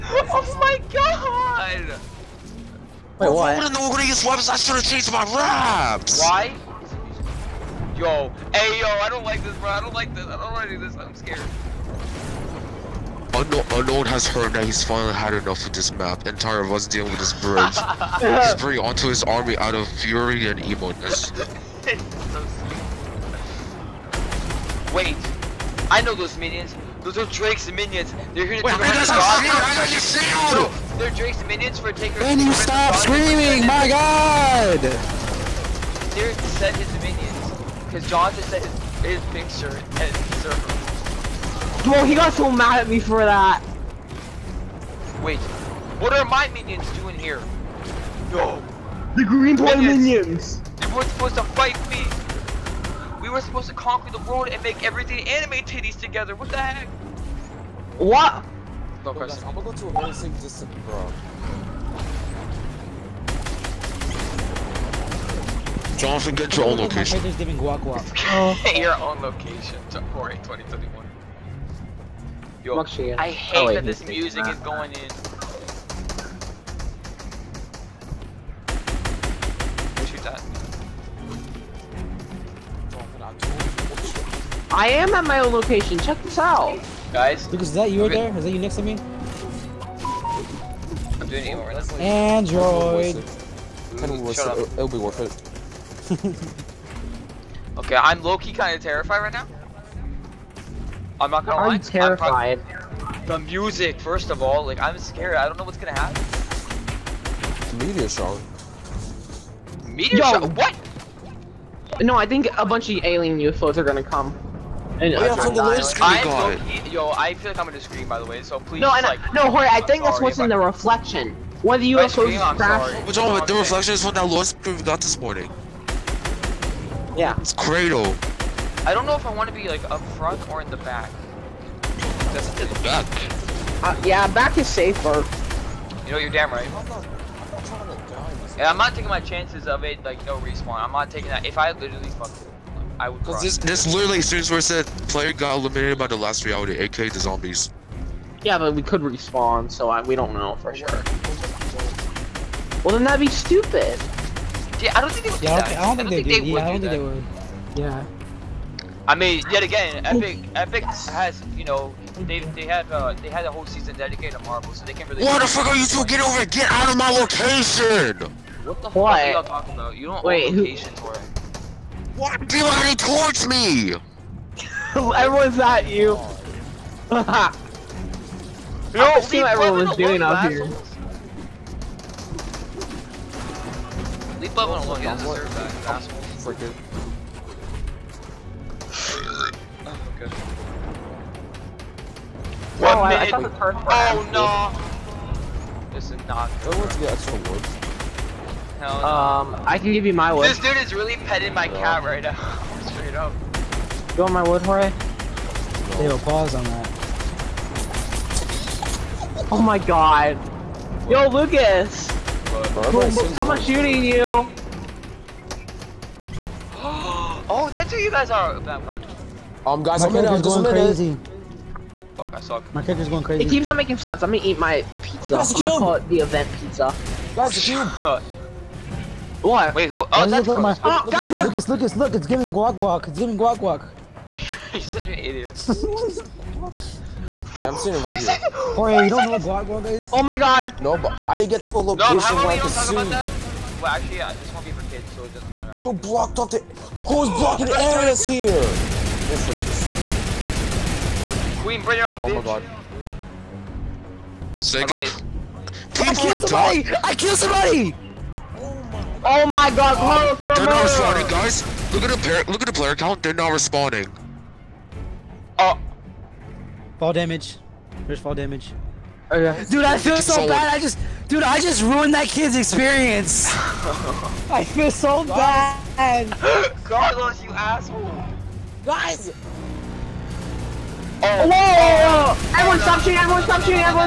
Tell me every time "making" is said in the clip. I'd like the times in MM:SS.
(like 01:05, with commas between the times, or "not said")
03:43.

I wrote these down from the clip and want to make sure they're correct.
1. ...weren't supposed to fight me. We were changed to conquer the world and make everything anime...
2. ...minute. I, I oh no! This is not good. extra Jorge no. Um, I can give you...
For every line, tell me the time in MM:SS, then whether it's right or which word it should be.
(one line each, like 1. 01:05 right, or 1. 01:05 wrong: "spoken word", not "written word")
1. 00:50 wrong: "supposed", not "changed"
2. 03:13 wrong: "Hell", not "Jorge".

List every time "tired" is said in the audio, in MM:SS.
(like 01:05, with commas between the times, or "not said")
00:16.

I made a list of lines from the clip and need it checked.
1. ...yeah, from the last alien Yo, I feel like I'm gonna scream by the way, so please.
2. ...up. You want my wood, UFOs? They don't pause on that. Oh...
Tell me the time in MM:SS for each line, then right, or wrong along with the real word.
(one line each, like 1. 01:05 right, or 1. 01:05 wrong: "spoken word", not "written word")
1. 01:55 wrong: "screen", not "alien"
2. 03:23 wrong: "Jorge", not "UFOs".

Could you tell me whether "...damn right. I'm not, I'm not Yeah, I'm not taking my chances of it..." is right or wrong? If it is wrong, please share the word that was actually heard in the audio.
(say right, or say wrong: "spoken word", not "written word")
right.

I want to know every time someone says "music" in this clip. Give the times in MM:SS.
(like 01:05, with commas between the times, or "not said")
01:14, 01:43.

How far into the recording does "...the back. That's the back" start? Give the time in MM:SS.
02:10.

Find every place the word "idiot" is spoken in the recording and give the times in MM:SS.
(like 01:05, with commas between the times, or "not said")
03:55.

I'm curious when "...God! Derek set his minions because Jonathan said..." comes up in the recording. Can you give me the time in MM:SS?
00:33.